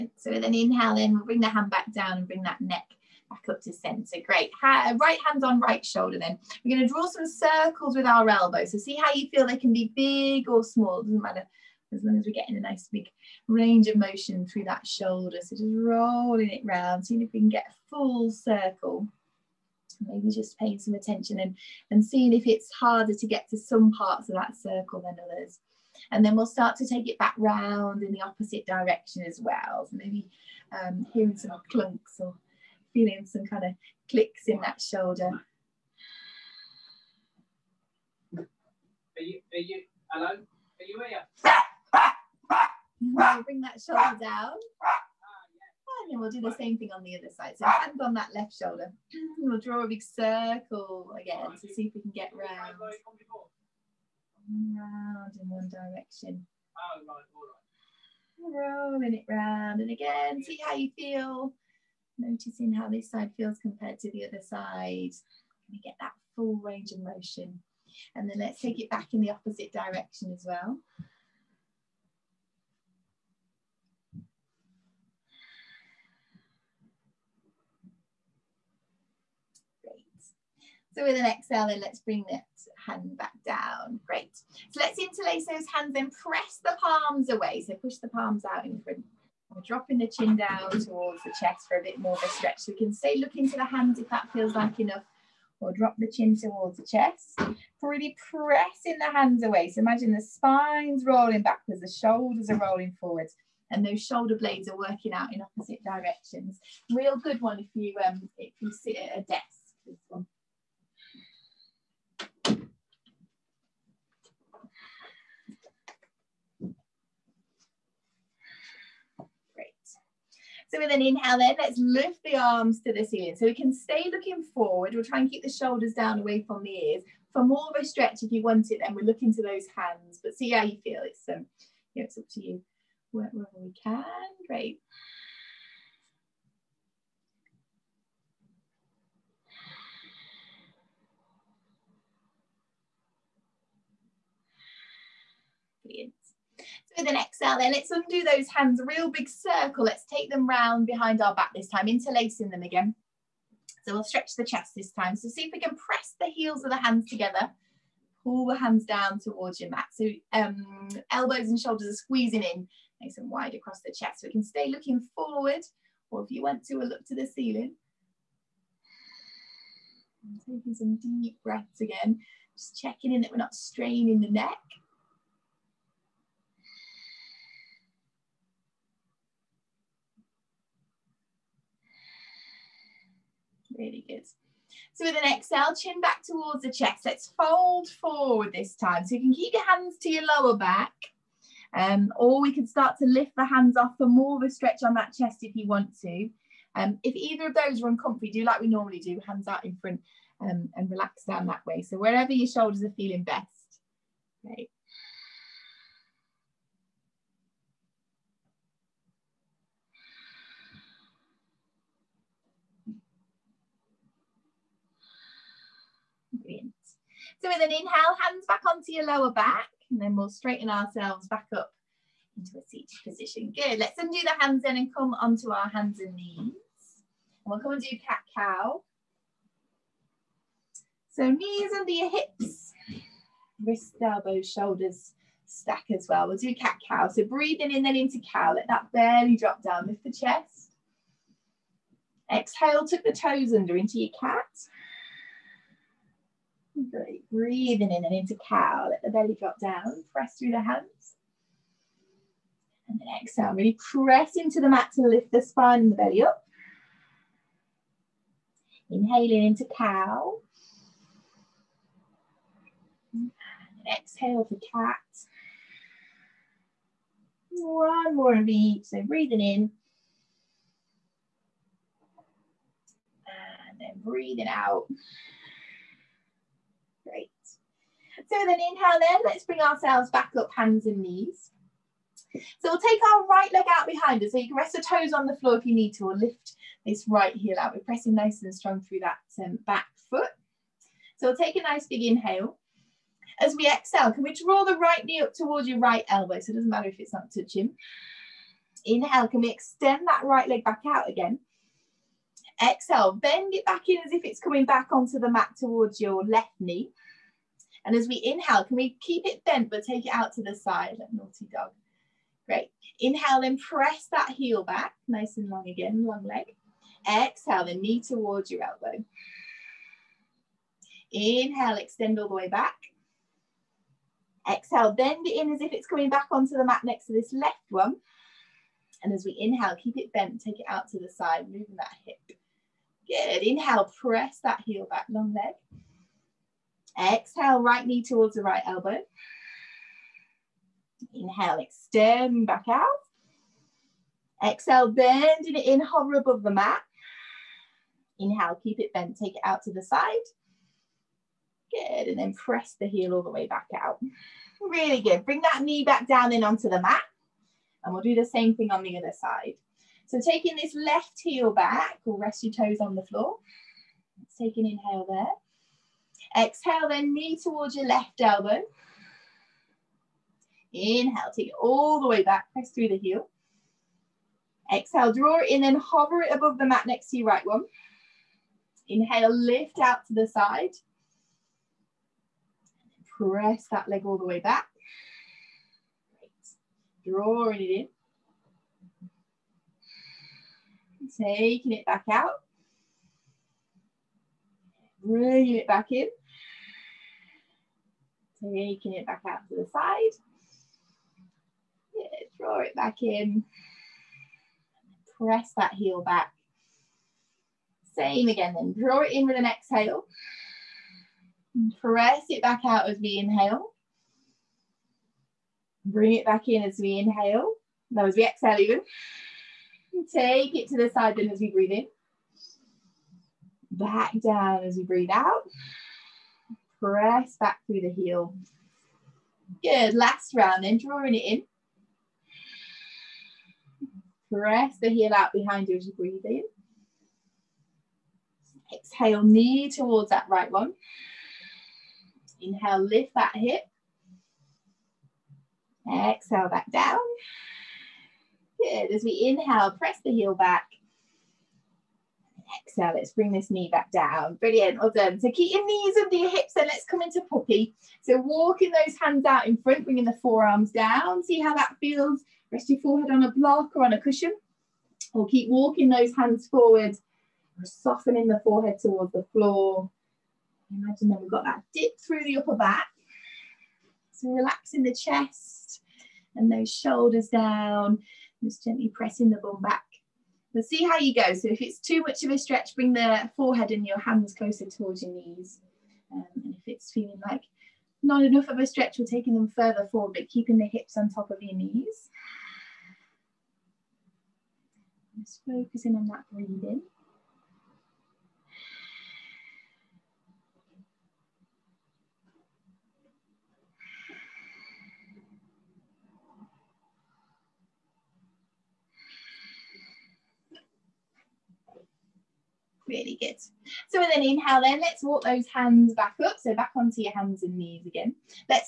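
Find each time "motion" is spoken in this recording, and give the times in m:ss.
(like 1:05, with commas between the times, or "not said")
0:13, 1:06.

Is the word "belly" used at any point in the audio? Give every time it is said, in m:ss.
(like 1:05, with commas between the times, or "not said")
4:09, 4:15.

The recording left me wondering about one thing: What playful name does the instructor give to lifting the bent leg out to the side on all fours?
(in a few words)
Naughty dog.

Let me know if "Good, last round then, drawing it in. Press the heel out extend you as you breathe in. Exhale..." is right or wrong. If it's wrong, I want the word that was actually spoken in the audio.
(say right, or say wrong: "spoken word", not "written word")
wrong: "behind", not "extend".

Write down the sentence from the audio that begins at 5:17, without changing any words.
Exhale, the knee towards your elbow.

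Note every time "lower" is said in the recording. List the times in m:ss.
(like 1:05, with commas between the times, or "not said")
3:10, 3:39.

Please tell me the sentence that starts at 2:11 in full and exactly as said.
It's, um, yeah, it's up to you wherever we can.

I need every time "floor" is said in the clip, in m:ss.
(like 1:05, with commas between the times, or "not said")
4:45, 6:03, 7:49.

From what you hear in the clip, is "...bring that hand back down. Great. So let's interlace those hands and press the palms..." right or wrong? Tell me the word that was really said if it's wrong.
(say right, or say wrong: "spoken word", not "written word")
right.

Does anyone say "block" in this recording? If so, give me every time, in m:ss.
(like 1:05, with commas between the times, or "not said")
7:43.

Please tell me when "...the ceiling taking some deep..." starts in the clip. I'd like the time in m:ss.
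2:47.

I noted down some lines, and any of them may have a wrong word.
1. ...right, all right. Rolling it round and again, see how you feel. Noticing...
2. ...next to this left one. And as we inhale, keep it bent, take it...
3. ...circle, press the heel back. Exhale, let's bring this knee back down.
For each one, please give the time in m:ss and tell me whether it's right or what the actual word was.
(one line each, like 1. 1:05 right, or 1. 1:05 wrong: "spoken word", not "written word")
1. 0:57 right
2. 5:26 right
3. 7:29 wrong: "inhale", not "circle".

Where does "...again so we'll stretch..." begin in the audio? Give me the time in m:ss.
2:32.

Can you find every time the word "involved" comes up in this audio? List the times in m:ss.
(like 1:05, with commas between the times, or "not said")
not said.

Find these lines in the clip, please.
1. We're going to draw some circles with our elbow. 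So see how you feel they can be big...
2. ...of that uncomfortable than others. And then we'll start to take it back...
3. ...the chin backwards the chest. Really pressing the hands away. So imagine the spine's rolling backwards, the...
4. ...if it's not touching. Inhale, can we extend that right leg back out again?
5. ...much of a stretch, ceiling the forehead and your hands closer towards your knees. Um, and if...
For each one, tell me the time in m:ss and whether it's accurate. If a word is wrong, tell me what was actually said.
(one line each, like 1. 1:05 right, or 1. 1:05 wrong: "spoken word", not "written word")
1. 0:06 right
2. 0:24 wrong: "circle", not "uncomfortable"
3. 1:35 wrong: "towards", not "backwards"
4. 4:56 right
5. 8:02 wrong: "bring", not "ceiling".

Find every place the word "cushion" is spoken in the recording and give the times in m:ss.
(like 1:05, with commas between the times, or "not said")
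7:43.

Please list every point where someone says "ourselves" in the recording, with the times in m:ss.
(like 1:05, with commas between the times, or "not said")
3:40, 4:39.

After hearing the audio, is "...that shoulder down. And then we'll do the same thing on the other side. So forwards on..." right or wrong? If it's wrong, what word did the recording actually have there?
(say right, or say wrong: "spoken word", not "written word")
wrong: "hands", not "forwards".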